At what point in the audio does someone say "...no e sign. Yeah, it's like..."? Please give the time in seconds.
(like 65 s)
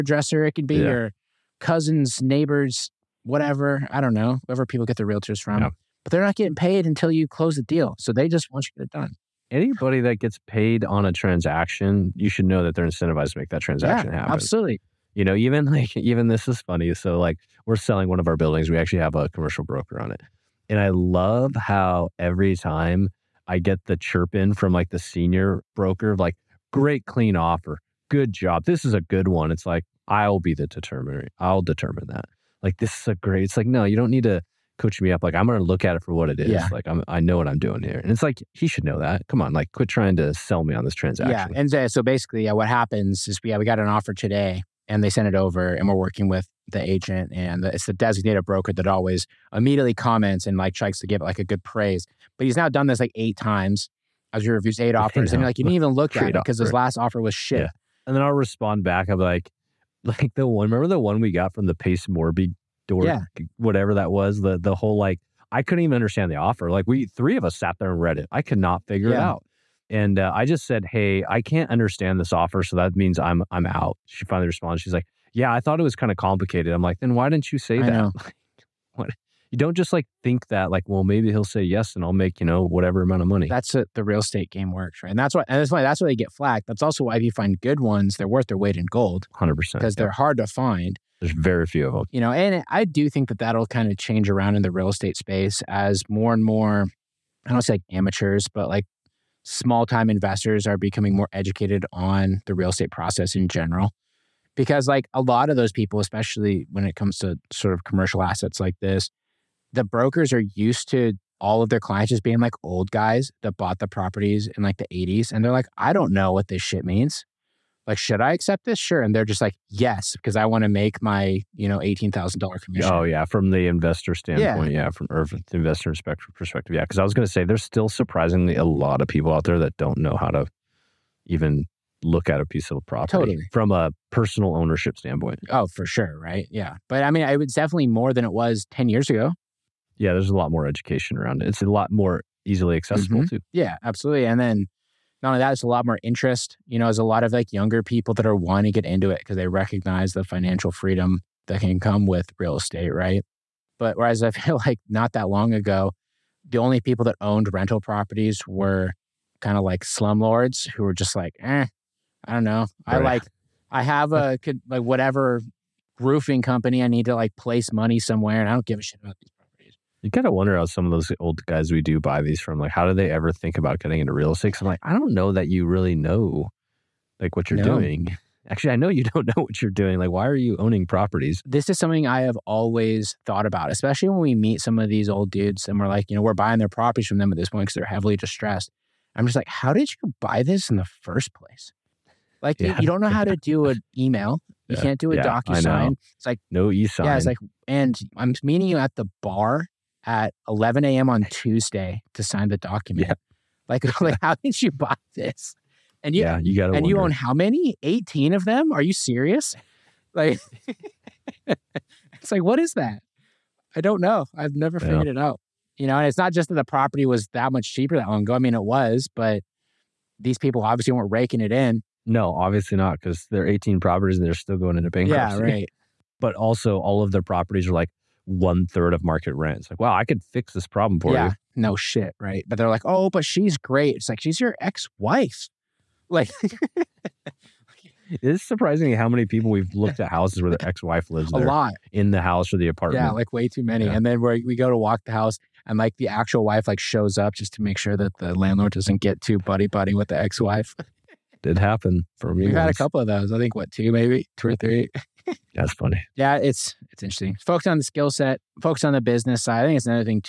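196 s.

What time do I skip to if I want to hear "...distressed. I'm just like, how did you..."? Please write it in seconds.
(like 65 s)
188 s.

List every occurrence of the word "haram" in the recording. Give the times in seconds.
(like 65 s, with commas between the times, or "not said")
not said.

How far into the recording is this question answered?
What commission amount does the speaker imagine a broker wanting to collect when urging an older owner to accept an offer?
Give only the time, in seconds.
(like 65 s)
121 s.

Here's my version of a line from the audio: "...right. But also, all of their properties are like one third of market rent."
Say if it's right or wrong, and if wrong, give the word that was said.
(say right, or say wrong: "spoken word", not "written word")
right.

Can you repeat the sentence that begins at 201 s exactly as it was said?
on Tuesday to sign the document.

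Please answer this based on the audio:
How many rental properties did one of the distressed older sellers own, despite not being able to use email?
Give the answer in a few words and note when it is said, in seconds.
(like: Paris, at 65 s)
18, at 207 s.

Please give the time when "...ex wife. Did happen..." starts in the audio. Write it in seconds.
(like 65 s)
250 s.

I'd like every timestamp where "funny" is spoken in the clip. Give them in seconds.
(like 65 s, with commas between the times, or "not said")
16 s, 255 s.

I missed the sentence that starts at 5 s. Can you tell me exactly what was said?
Yeah but they're not getting paid until you close the deal.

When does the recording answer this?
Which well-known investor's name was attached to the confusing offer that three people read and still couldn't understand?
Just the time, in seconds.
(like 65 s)
61 s.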